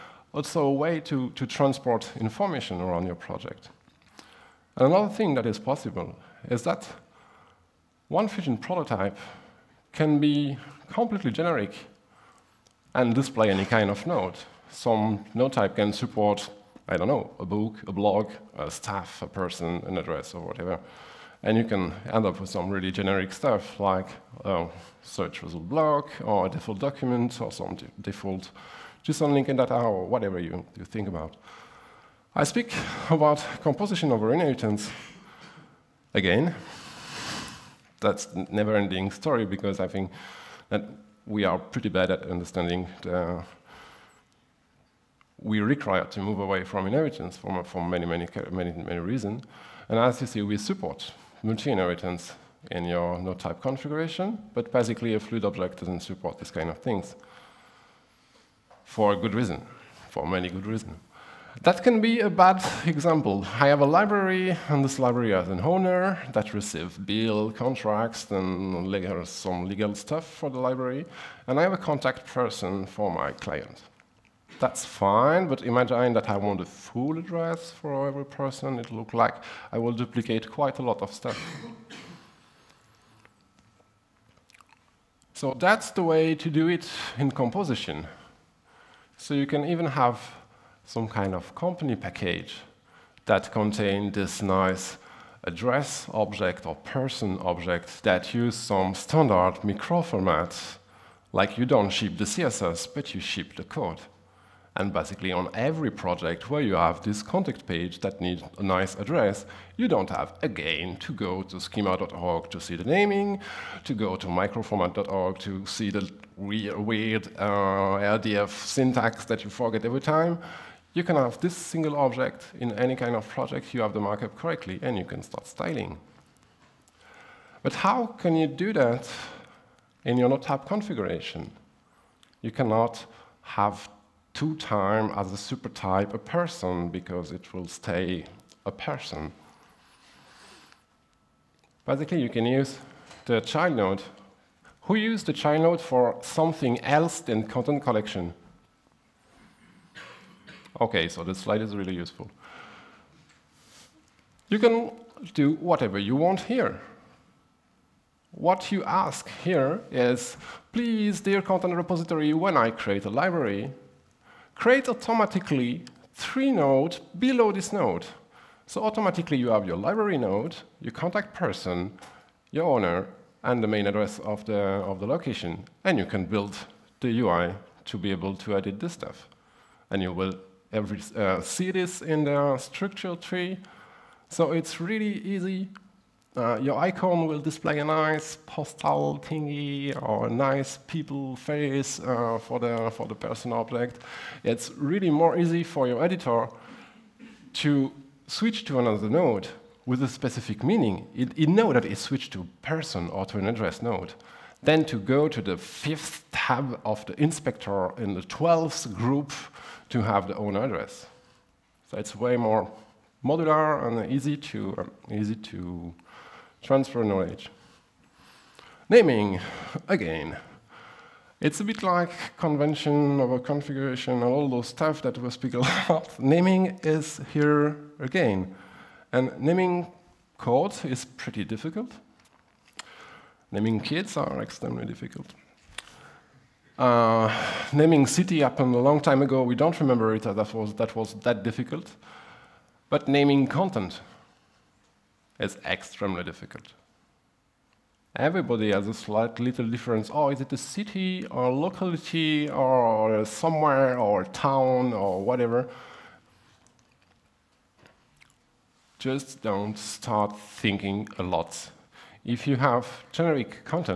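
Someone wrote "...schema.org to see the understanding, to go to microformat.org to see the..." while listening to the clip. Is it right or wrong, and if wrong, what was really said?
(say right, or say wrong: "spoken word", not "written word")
wrong: "naming", not "understanding".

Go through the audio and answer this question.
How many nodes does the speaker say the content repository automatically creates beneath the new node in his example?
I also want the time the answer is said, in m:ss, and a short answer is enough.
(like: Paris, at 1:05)
3, at 2:46.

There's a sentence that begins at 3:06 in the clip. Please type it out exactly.
Uh, your icon will display a nice postal thingy or a nice people face uh, for, the, for the person object.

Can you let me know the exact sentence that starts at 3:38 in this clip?
Naming, again, it's a bit like convention a configuration and all those stuff that we speak about.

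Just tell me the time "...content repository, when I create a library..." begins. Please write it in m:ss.
2:41.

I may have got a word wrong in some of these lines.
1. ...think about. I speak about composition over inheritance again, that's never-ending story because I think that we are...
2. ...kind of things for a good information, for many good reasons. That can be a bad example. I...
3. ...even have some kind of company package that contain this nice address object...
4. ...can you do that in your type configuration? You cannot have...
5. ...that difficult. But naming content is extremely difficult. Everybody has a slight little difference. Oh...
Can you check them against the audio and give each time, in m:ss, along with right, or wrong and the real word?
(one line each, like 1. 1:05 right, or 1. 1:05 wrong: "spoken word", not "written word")
1. 0:30 right
2. 0:56 wrong: "reason", not "information"
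3. 1:29 right
4. 2:08 right
5. 4:01 right.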